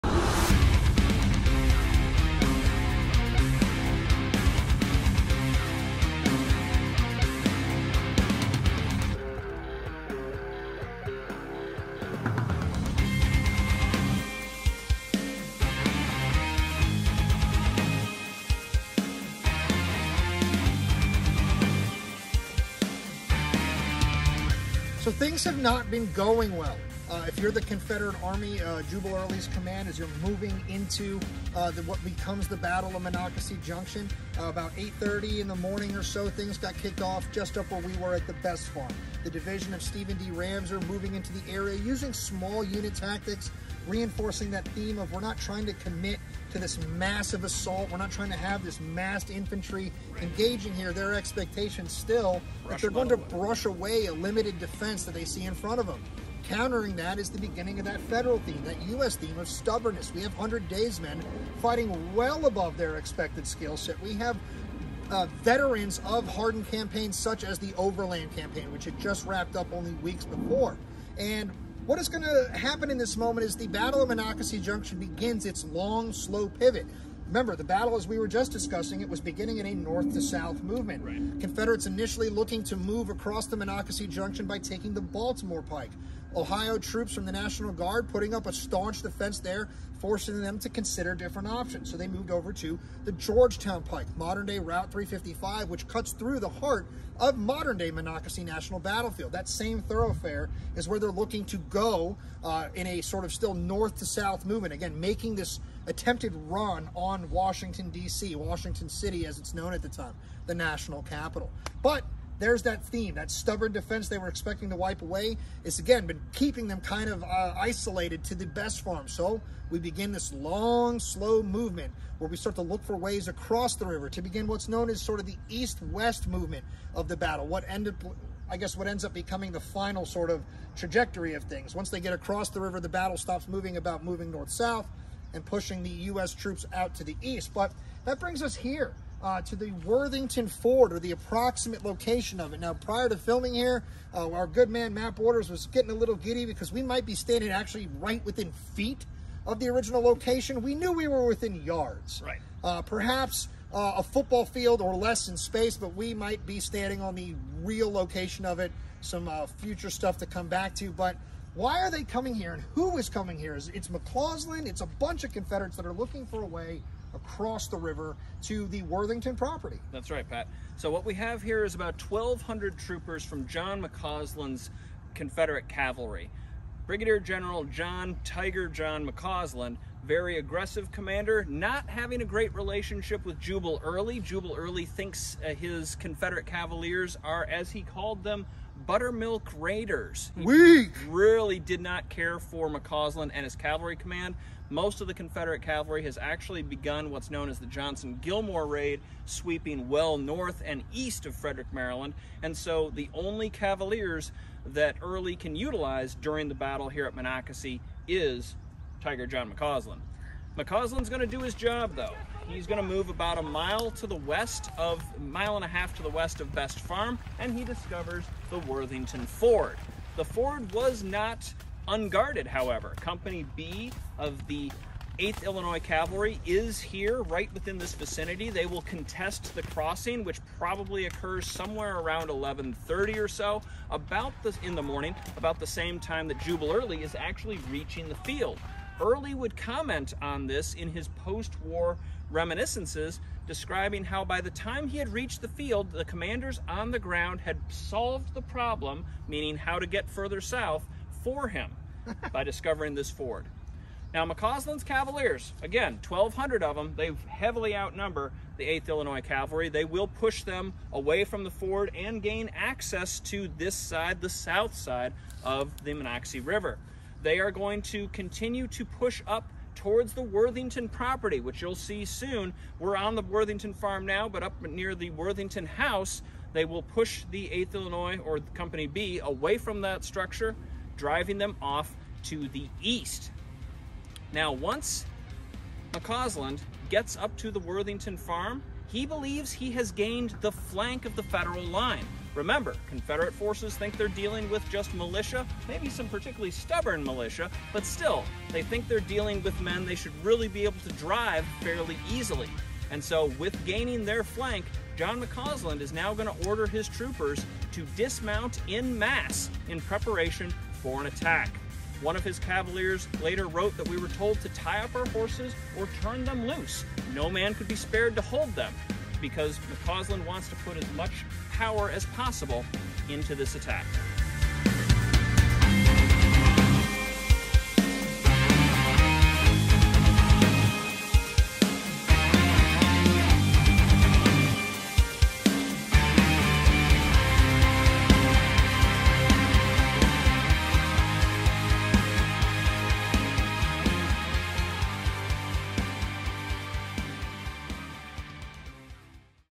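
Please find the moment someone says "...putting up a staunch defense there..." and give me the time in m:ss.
1:28.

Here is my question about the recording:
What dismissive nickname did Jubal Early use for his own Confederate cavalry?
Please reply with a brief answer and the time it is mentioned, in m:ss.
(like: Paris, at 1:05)
Buttermilk Raiders, at 3:08.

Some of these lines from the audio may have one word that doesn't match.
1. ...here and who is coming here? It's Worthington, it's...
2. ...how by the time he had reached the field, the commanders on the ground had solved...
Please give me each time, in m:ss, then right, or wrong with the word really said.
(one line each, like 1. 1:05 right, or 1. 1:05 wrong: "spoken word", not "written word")
1. 2:42 wrong: "McCausland", not "Worthington"
2. 4:04 right.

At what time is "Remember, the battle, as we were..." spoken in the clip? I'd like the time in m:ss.
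1:17.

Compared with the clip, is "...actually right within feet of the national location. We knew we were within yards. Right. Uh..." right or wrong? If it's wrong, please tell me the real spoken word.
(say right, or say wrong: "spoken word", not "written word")
wrong: "original", not "national".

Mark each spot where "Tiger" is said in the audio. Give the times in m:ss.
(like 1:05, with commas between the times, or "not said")
2:58, 3:29.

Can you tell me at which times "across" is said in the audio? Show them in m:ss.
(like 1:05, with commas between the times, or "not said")
1:23, 2:03, 2:12, 2:47.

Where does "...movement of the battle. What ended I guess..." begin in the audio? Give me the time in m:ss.
2:06.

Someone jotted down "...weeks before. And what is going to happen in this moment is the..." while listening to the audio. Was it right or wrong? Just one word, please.
right.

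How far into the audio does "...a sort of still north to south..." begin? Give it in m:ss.
1:42.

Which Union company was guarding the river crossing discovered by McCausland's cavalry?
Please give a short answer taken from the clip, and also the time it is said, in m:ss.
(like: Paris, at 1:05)
Company B, 8th Illinois Cavalry, at 3:42.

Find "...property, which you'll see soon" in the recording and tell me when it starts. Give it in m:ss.
4:30.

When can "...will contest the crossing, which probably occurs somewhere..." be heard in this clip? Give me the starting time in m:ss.
3:48.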